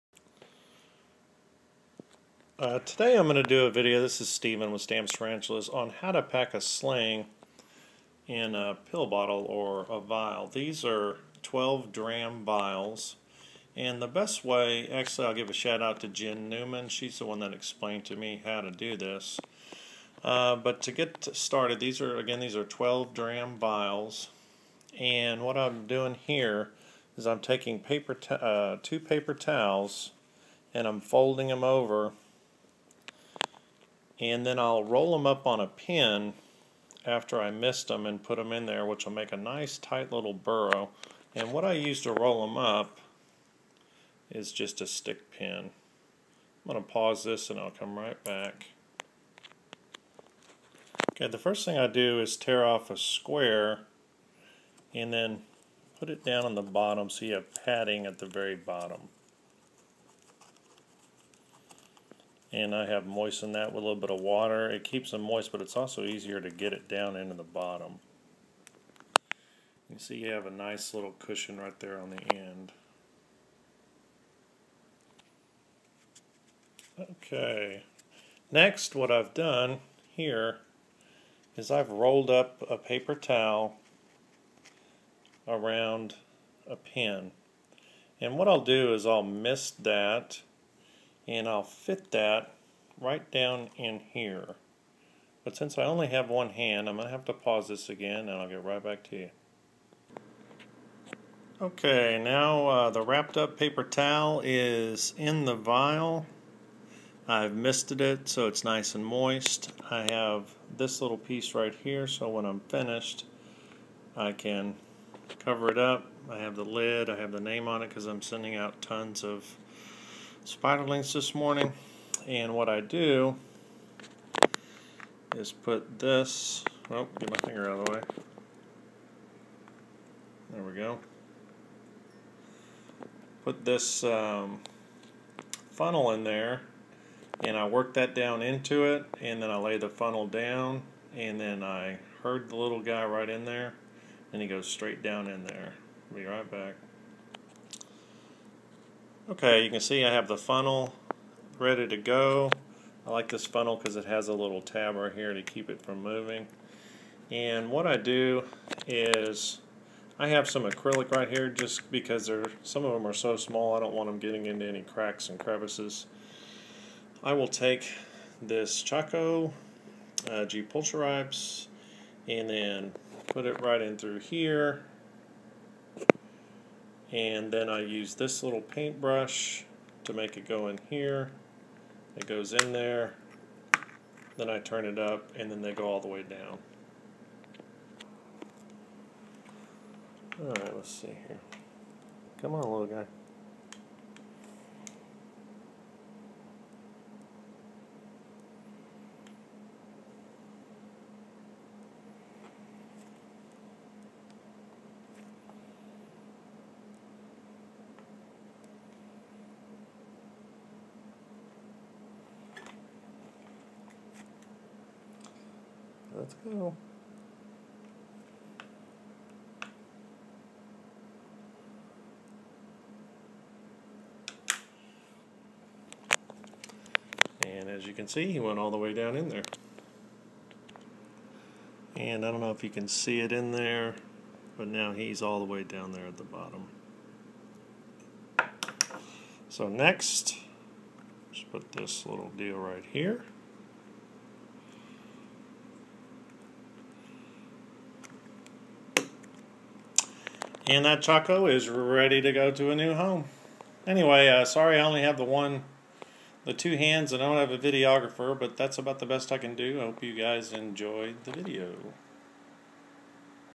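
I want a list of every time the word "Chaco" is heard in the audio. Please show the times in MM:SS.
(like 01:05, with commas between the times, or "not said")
02:48, 04:11.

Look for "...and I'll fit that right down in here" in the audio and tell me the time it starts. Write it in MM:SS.
01:31.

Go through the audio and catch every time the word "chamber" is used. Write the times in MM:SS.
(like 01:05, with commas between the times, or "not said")
not said.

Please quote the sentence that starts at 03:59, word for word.
So next, just put this little deal right here.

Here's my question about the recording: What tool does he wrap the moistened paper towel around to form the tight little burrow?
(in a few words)
A stick pin.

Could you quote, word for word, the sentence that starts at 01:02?
and I have moistened that with a little bit of water.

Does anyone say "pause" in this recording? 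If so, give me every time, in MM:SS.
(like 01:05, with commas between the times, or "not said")
00:46, 01:37.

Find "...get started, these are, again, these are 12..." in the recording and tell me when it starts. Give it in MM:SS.
00:20.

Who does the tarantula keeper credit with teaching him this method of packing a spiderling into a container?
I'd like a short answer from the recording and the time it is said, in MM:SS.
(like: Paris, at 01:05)
Jen Newman, at 00:16.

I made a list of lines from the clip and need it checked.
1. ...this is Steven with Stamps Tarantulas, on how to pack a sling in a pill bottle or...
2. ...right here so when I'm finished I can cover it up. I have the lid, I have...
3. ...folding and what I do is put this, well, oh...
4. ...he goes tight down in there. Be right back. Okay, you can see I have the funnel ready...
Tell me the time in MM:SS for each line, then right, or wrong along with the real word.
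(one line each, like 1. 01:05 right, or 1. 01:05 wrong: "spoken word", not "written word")
1. 00:04 right
2. 01:51 right
3. 02:01 wrong: "morning", not "folding"
4. 02:24 wrong: "straight", not "tight".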